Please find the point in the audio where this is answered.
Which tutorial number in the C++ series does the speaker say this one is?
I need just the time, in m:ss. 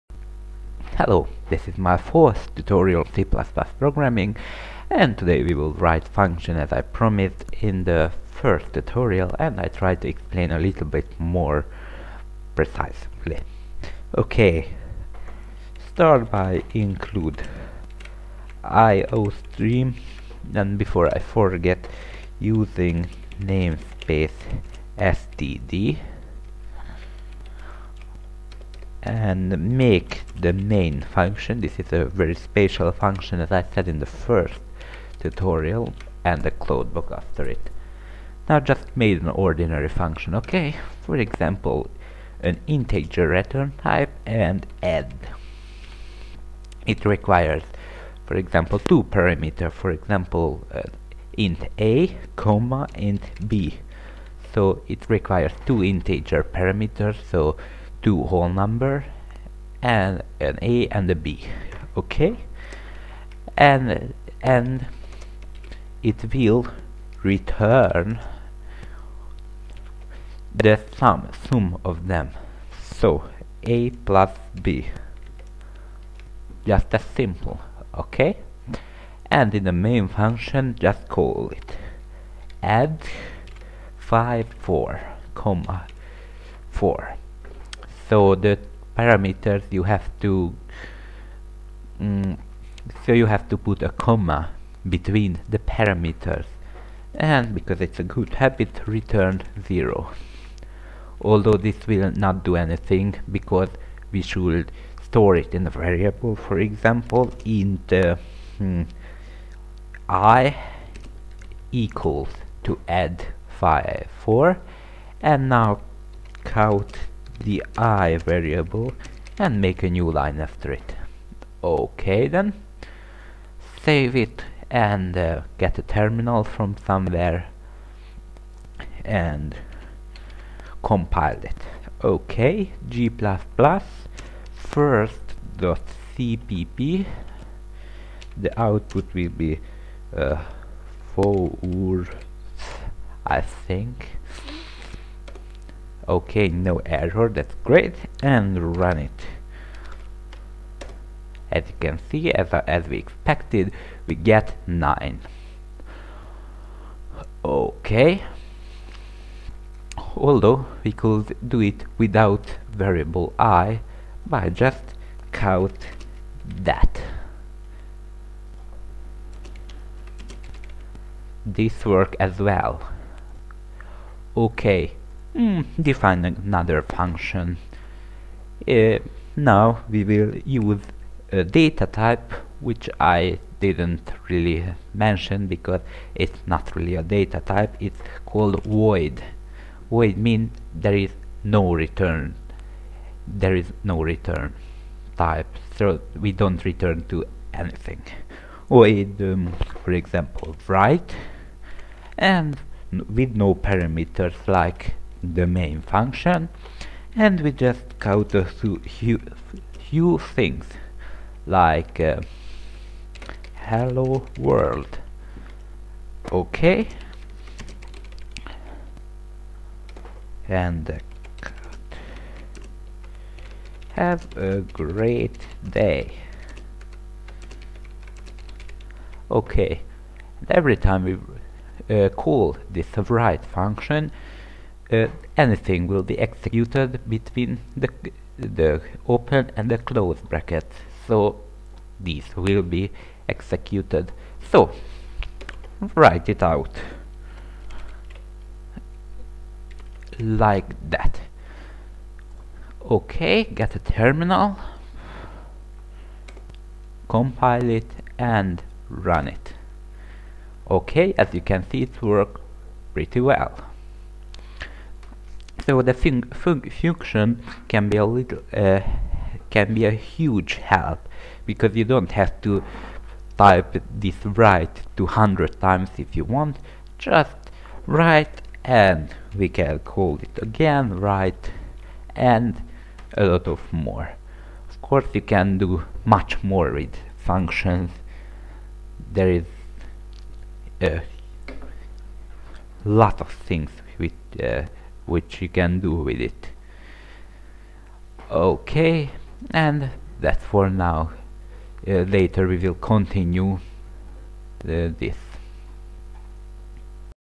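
0:01.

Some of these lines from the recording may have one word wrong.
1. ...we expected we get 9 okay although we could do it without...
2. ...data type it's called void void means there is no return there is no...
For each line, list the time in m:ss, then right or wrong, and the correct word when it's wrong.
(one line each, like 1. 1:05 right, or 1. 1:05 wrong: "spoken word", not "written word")
1. 2:32 right
2. 3:07 right.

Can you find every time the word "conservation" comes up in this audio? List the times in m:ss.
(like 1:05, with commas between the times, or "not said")
not said.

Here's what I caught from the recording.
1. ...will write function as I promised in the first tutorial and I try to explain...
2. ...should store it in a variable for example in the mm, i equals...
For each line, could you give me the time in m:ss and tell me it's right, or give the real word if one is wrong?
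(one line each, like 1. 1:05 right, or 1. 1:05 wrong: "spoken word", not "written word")
1. 0:05 right
2. 1:44 right.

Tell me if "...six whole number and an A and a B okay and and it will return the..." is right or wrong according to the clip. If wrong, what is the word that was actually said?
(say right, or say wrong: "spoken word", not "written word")
wrong: "two", not "six".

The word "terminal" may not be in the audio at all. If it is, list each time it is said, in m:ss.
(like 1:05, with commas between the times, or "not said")
2:05, 4:13.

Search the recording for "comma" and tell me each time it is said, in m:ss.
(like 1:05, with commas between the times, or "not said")
0:52, 1:25, 1:34.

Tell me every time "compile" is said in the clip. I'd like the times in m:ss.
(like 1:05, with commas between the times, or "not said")
2:10, 4:17.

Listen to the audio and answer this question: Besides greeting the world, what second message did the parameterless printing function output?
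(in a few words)
have a great day.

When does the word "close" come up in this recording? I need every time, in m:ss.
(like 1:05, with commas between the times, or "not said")
3:59.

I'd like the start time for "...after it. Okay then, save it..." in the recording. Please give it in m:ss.
2:00.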